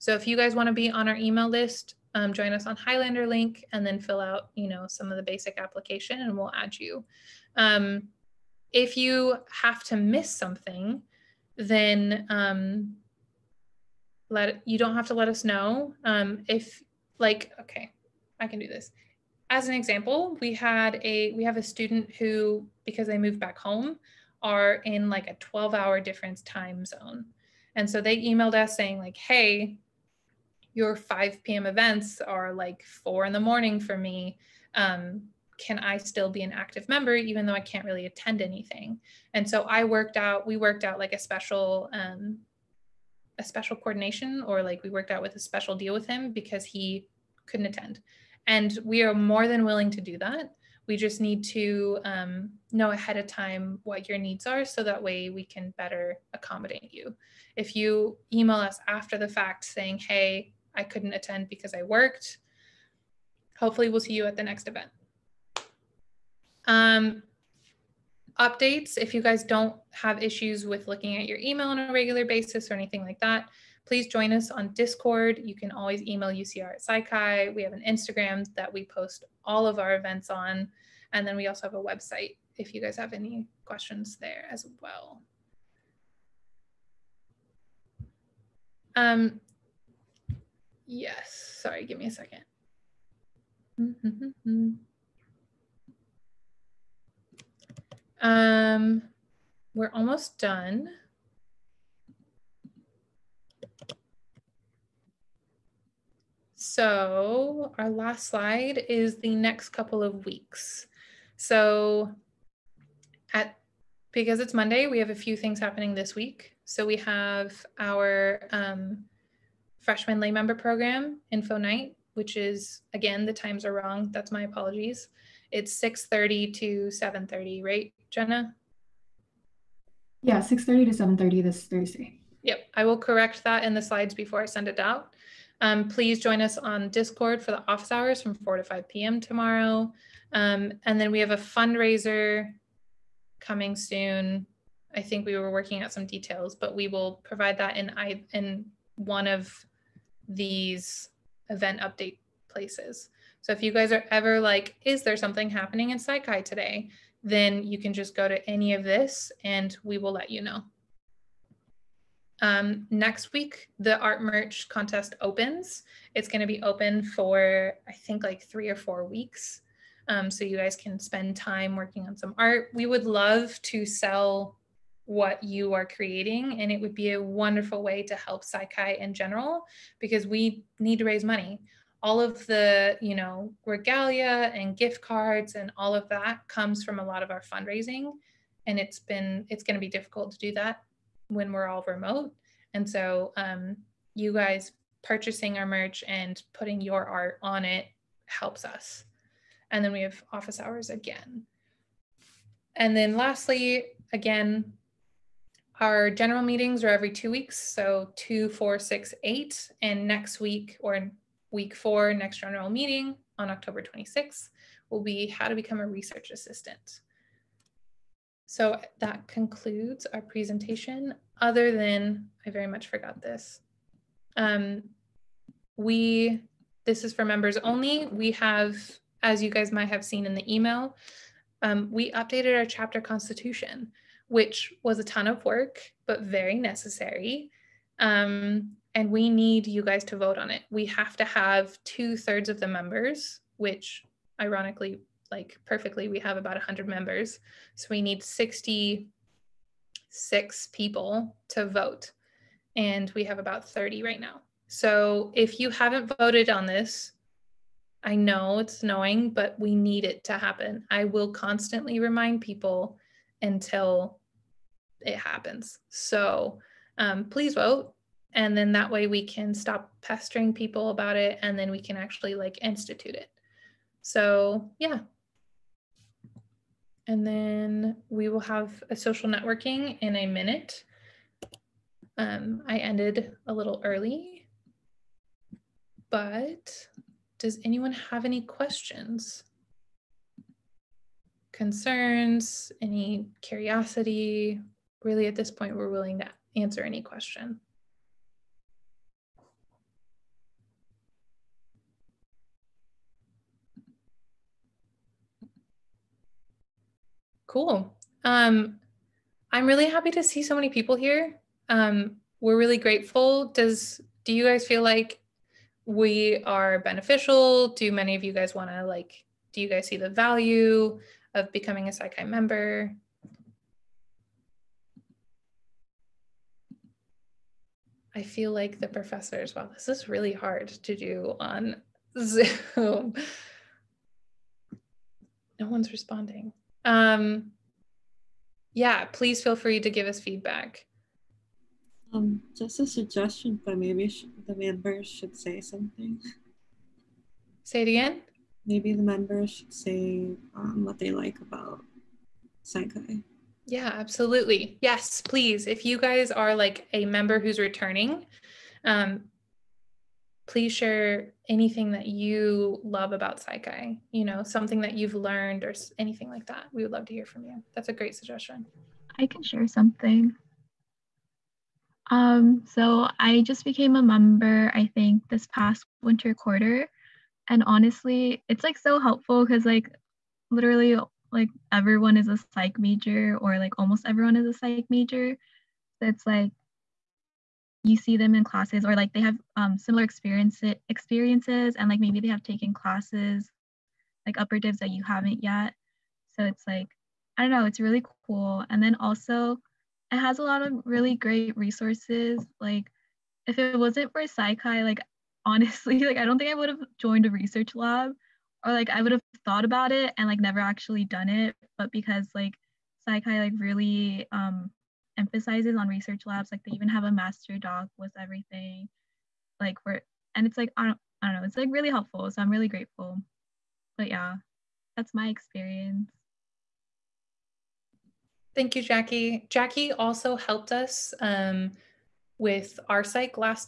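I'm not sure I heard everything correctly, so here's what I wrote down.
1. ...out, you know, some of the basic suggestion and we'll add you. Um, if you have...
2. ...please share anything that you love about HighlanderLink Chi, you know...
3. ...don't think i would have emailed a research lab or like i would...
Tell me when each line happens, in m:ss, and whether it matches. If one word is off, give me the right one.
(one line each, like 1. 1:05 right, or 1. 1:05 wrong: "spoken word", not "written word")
1. 0:04 wrong: "application", not "suggestion"
2. 6:00 wrong: "Psi", not "HighlanderLink"
3. 6:46 wrong: "joined", not "emailed".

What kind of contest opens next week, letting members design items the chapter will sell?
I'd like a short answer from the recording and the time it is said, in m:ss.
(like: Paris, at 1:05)
art merch contest, at 2:43.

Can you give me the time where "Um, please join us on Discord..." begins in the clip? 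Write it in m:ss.
2:15.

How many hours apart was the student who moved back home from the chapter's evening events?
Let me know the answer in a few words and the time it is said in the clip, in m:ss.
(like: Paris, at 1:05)
12, at 0:25.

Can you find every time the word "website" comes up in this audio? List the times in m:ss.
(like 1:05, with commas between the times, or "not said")
1:21.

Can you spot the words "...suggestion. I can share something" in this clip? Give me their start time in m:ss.
6:08.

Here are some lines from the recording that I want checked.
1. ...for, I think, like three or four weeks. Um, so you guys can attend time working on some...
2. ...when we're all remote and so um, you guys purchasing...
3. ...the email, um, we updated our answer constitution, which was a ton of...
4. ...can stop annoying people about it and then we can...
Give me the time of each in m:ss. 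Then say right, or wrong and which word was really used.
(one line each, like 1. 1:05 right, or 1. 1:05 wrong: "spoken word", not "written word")
1. 2:47 wrong: "spend", not "attend"
2. 3:11 right
3. 3:50 wrong: "chapter", not "answer"
4. 4:29 wrong: "pestering", not "annoying".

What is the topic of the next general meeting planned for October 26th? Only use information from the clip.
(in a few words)
how to become a research assistant.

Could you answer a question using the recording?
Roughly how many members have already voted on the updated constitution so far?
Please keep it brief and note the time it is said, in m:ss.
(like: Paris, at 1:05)
30, at 4:13.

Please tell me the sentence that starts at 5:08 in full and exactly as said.
Um, I'm really happy to see so many people here.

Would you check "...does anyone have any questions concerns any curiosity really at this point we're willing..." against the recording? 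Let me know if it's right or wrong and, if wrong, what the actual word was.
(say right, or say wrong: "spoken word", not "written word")
right.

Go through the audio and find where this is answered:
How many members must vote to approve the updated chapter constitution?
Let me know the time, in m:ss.
4:08.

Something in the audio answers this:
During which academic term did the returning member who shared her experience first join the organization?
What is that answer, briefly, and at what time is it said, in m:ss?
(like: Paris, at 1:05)
winter quarter, at 6:16.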